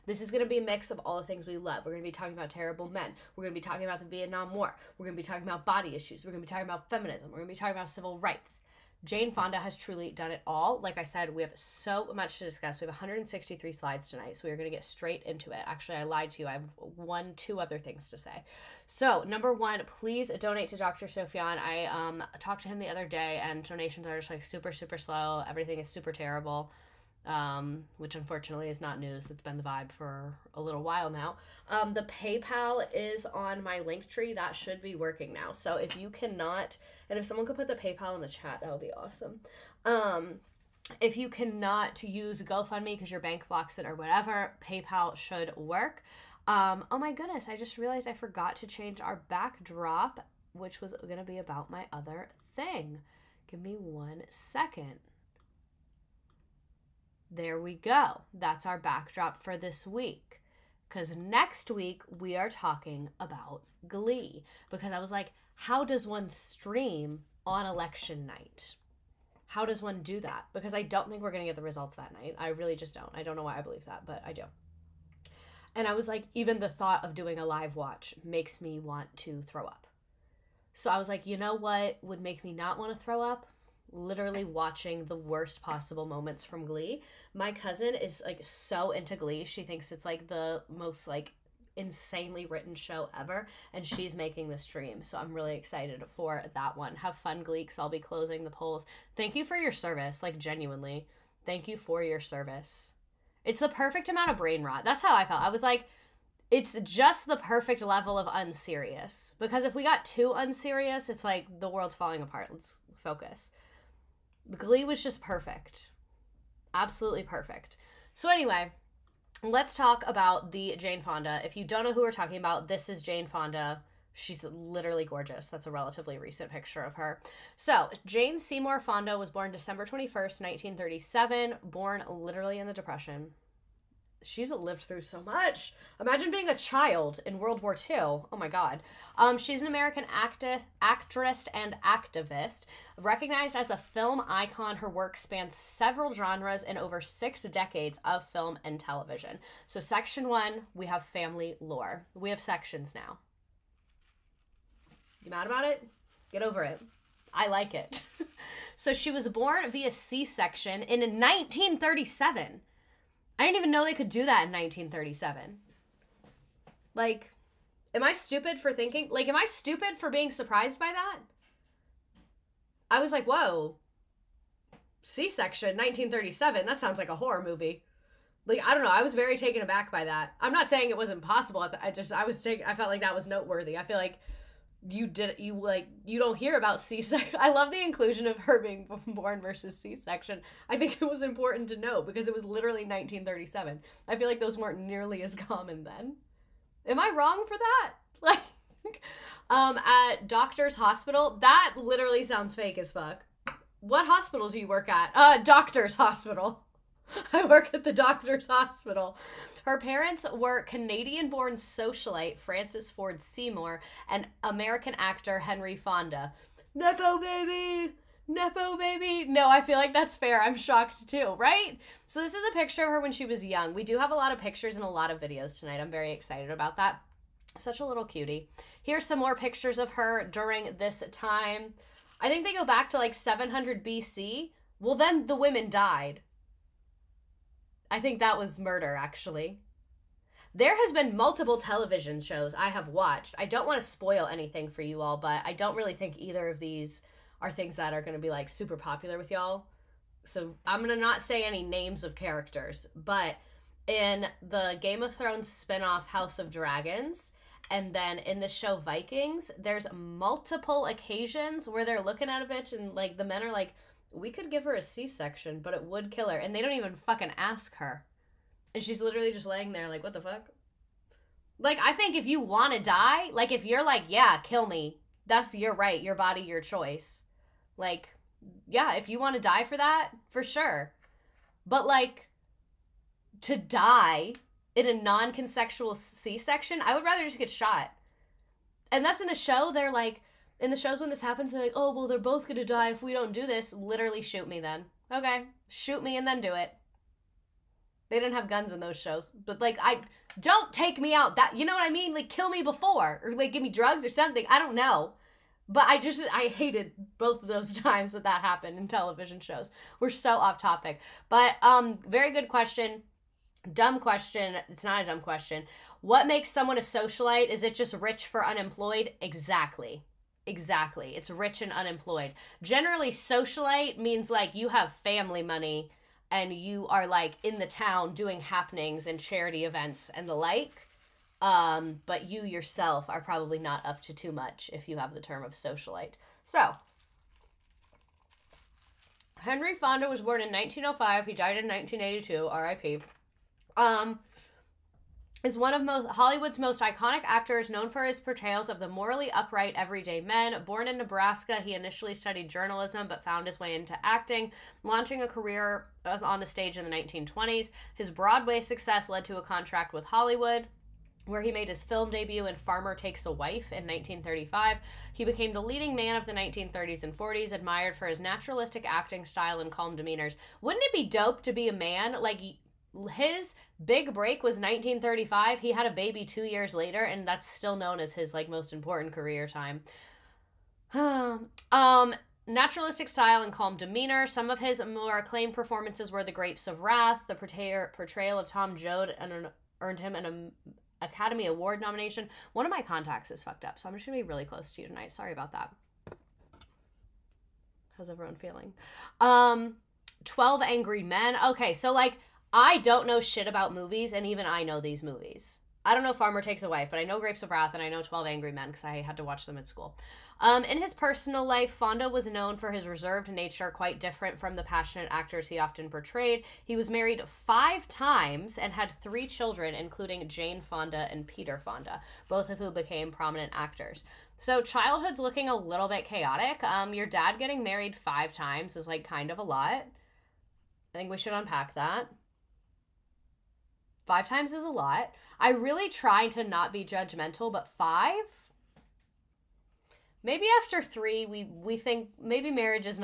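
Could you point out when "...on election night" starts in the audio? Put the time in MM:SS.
01:07.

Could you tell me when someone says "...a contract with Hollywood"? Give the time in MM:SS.
05:59.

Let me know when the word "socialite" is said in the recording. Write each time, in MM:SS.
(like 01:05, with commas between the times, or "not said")
03:31, 05:16, 05:23, 05:35.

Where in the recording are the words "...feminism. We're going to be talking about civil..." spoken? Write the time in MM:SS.
00:06.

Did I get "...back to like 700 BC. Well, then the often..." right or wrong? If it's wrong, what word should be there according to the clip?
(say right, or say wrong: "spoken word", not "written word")
wrong: "women", not "often".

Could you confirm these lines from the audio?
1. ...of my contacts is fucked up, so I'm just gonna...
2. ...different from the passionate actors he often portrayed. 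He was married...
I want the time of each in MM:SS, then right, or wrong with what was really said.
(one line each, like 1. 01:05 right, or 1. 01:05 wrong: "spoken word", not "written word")
1. 06:32 right
2. 06:53 right.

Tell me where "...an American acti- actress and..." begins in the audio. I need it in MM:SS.
02:19.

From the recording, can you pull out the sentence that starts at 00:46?
Um, oh my goodness, I just realized I forgot to change our backdrop, which was going to be about my other thing.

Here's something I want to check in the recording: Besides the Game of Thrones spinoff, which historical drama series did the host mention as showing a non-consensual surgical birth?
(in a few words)
Vikings.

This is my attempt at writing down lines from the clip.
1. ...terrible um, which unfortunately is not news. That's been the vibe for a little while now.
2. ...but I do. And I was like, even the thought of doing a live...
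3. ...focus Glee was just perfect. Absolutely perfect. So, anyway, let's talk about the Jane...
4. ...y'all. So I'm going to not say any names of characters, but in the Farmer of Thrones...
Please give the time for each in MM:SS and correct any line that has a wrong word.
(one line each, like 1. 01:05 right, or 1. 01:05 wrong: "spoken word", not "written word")
1. 00:26 right
2. 01:14 right
3. 01:52 right
4. 04:09 wrong: "Game", not "Farmer".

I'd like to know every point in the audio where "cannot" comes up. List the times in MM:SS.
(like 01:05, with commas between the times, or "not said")
00:36, 00:41.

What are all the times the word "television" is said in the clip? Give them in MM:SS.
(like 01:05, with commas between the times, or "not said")
02:28, 04:01, 05:08.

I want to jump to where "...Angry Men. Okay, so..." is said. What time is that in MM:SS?
06:40.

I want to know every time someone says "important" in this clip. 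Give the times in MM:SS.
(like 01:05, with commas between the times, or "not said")
03:11, 06:18.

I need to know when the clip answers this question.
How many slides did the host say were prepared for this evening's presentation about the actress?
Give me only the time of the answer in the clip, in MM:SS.
00:12.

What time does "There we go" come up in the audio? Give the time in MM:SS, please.
00:57.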